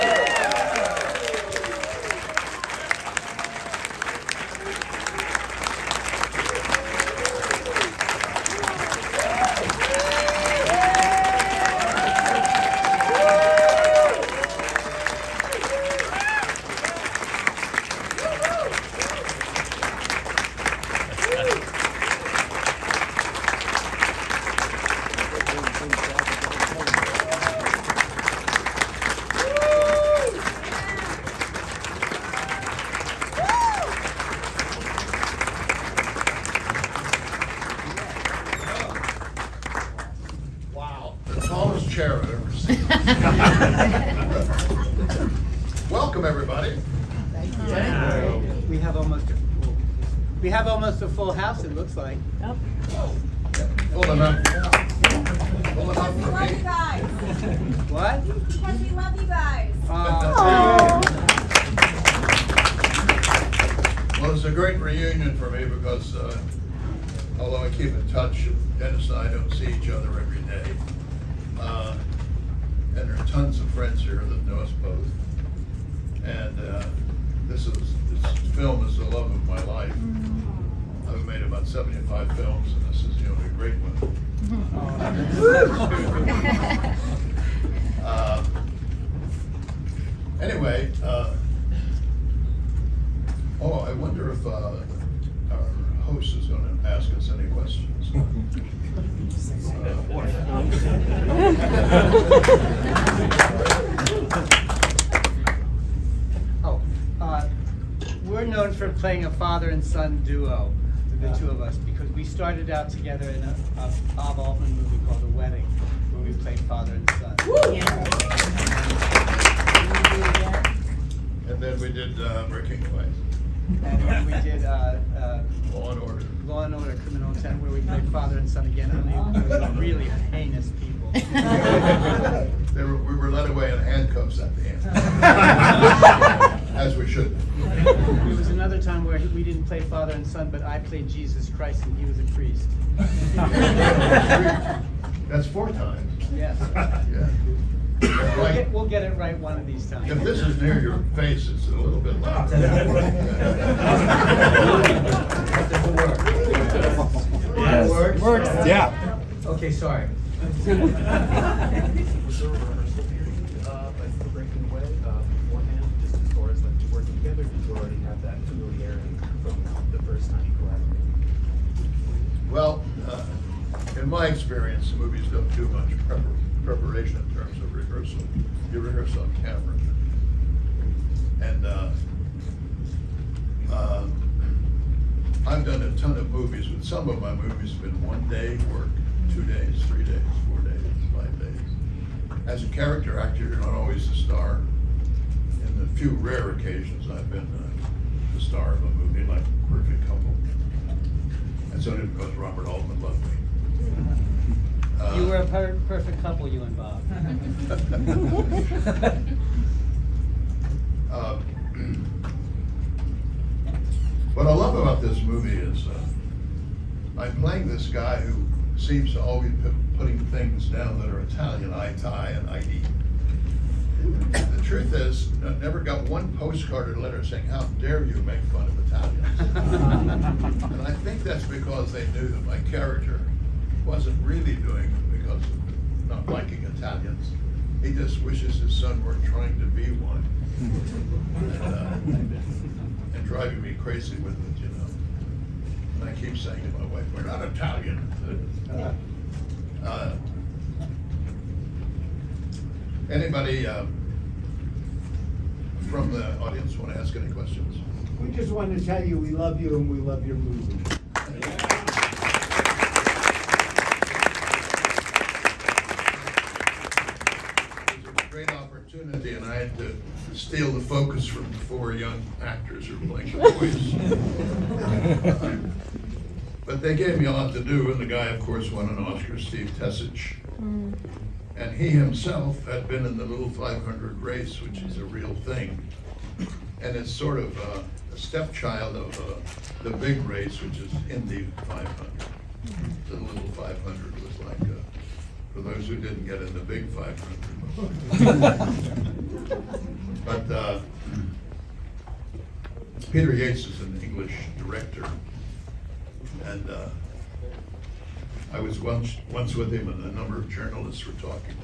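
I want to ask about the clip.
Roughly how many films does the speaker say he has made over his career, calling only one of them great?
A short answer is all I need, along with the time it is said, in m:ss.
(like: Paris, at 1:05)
75, at 1:21.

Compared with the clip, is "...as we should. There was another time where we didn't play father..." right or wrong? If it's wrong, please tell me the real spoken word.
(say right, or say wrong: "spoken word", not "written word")
right.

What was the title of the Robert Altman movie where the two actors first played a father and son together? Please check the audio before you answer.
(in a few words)
The Wedding.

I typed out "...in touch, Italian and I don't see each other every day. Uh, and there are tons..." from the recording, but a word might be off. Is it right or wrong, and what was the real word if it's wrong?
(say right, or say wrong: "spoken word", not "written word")
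wrong: "Dennis", not "Italian".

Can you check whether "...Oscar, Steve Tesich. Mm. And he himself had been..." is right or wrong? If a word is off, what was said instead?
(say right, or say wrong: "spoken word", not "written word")
right.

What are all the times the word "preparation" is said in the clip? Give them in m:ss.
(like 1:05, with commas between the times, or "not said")
2:56.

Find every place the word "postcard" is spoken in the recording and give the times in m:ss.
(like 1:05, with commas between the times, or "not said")
3:46.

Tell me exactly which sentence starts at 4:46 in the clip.
And it's sort of a, a stepchild of uh, the big race, which is in the 500.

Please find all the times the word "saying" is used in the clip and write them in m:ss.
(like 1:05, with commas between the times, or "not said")
3:47, 4:06.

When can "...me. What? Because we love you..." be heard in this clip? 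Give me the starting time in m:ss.
0:56.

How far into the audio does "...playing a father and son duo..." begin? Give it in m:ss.
1:48.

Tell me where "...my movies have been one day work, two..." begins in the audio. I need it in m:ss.
3:07.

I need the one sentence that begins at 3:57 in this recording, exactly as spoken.
He just wishes his son weren't trying to be one.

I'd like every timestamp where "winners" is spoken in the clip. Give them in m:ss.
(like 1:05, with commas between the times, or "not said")
not said.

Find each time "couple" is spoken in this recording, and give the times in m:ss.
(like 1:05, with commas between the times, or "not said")
3:20, 3:26.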